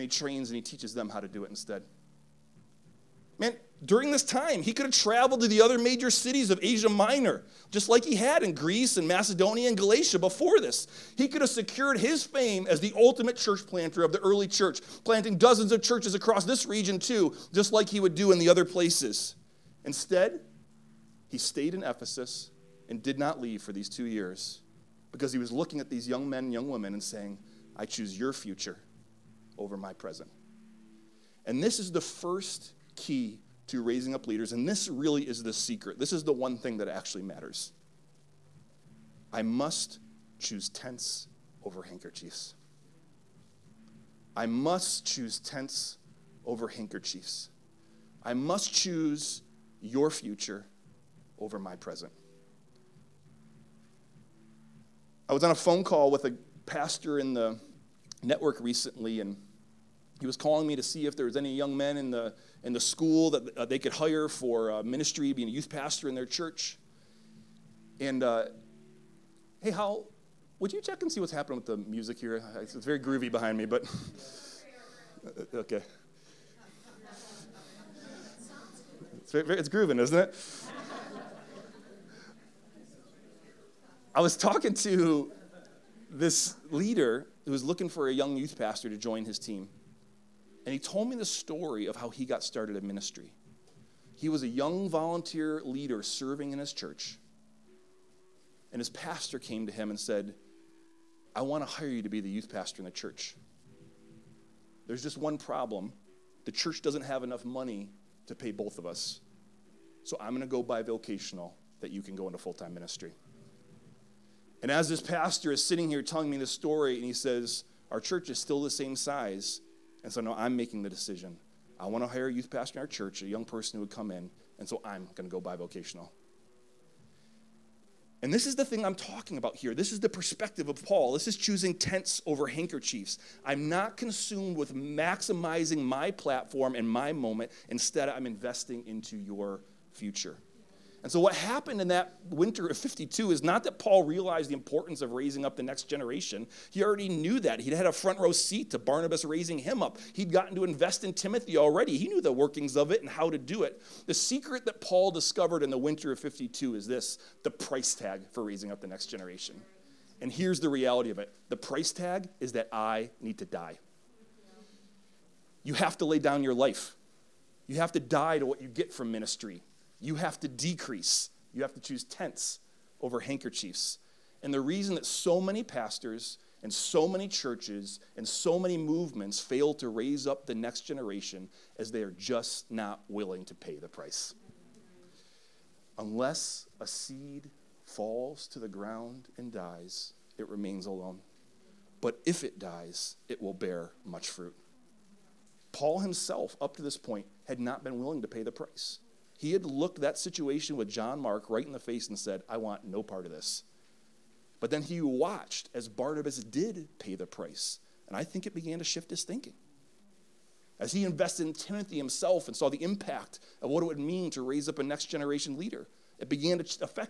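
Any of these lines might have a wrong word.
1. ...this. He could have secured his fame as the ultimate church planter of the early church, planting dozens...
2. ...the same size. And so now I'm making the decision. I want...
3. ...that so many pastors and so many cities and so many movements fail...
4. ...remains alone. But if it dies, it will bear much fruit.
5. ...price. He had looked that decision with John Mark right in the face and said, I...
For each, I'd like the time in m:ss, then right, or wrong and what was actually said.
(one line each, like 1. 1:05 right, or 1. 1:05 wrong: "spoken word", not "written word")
1. 0:10 right
2. 1:58 right
3. 2:54 wrong: "churches", not "cities"
4. 3:10 right
5. 3:18 wrong: "situation", not "decision".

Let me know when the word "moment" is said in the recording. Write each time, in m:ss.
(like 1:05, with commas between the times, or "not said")
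2:17.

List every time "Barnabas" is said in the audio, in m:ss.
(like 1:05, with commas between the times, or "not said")
2:28, 3:25.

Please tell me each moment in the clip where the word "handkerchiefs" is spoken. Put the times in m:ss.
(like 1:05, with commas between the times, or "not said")
0:41, 0:46, 2:12, 2:53.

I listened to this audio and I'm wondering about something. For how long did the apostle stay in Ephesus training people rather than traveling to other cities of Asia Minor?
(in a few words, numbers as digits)
2 years.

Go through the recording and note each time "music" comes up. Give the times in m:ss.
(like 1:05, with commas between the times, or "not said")
1:11.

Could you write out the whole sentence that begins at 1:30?
And he told me the story of how he got started in ministry.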